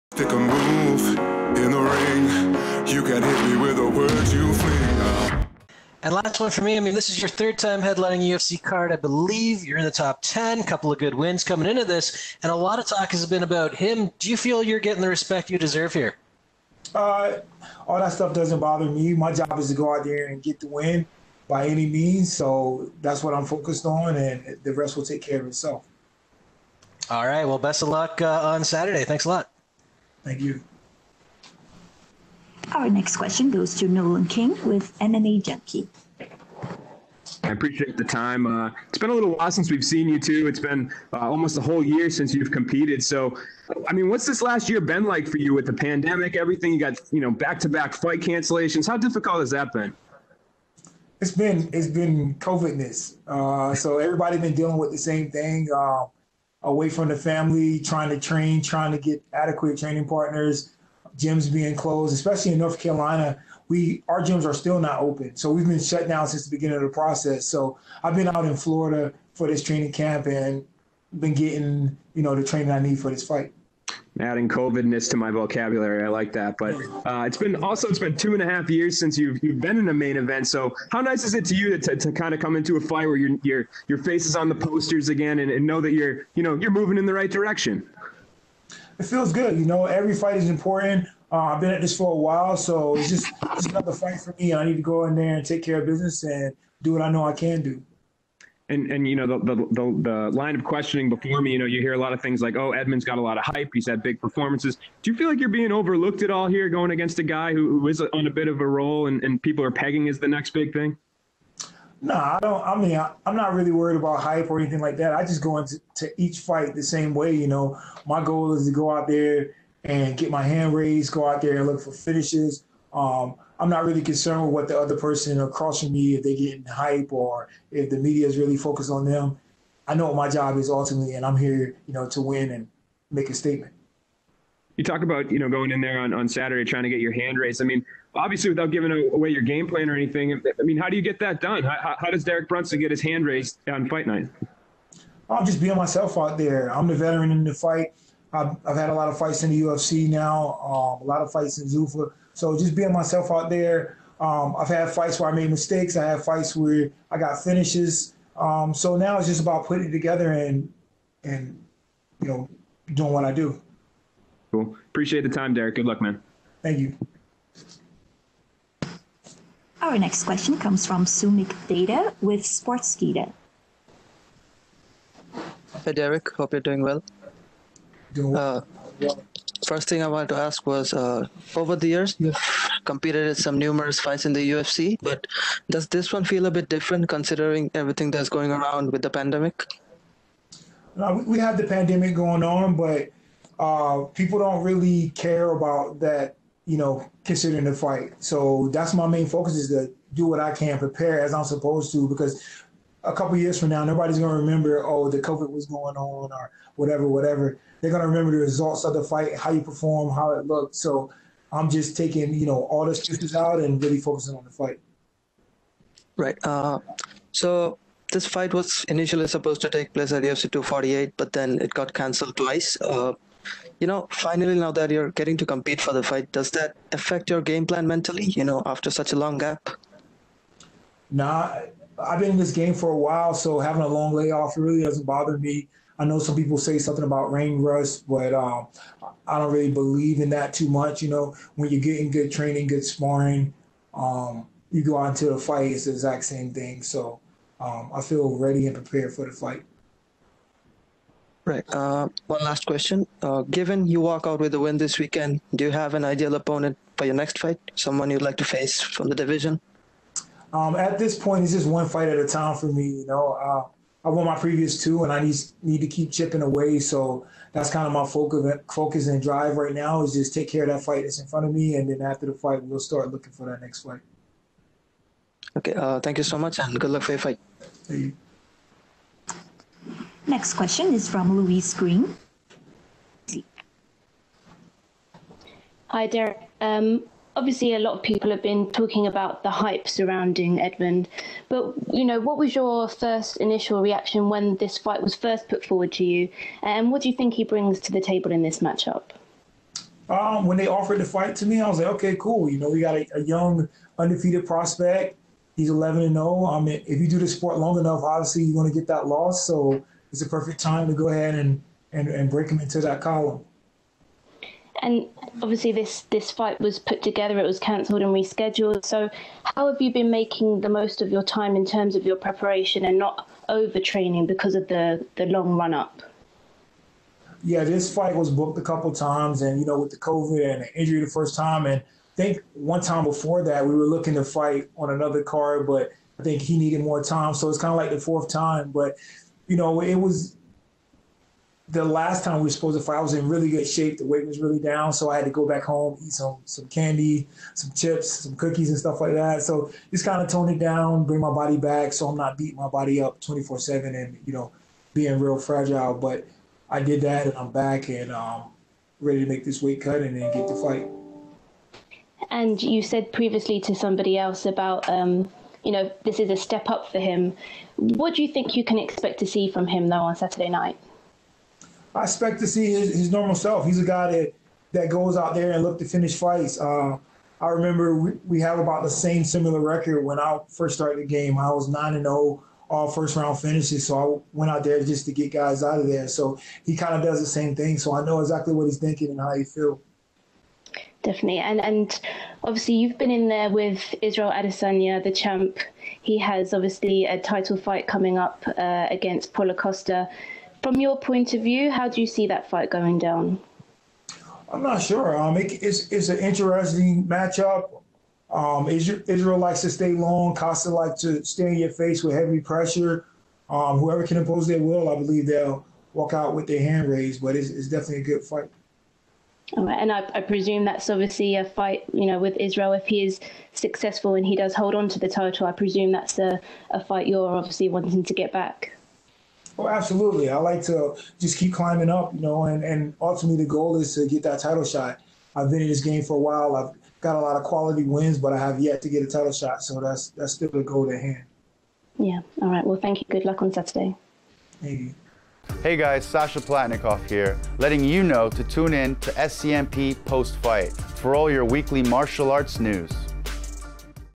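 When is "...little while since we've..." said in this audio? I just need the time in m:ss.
0:39.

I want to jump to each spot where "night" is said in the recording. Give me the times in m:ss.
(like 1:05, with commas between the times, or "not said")
2:24, 6:10.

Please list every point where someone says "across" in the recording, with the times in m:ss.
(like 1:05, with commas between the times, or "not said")
2:05.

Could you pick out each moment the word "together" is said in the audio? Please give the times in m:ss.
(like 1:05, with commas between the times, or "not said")
2:39, 5:17.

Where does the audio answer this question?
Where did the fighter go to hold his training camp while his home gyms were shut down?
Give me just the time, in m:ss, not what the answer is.
1:08.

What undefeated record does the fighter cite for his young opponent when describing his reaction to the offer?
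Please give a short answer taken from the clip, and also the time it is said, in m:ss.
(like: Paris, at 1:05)
11-0, at 5:05.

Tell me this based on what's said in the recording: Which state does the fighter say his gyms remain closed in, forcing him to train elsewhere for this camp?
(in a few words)
North Carolina.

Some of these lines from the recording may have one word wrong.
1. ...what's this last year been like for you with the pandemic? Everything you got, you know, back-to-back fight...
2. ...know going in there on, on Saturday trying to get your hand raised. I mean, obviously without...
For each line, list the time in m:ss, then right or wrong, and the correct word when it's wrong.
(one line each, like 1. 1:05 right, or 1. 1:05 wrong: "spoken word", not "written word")
1. 0:44 right
2. 2:15 right.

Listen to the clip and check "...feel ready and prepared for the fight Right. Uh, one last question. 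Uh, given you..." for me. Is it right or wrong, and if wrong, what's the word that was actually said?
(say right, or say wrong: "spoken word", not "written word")
right.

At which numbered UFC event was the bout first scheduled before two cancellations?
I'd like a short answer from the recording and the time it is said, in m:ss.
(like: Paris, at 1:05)
UFC 248, at 3:40.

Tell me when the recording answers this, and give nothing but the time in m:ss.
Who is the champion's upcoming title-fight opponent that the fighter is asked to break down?
6:39.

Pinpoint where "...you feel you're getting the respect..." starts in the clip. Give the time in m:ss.
0:14.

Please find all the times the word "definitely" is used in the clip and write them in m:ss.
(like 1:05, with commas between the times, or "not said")
6:31, 6:57.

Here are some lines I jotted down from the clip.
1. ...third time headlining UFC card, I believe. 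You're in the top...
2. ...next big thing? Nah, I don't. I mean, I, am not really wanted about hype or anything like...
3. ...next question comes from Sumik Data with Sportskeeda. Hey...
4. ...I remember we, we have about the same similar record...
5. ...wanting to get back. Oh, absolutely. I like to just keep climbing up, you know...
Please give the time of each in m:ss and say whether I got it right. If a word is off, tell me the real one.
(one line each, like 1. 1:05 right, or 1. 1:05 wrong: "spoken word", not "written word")
1. 0:07 right
2. 1:50 wrong: "worried", not "wanted"
3. 2:49 right
4. 6:17 right
5. 7:07 right.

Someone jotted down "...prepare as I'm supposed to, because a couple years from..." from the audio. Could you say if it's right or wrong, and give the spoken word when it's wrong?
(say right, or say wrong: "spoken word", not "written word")
right.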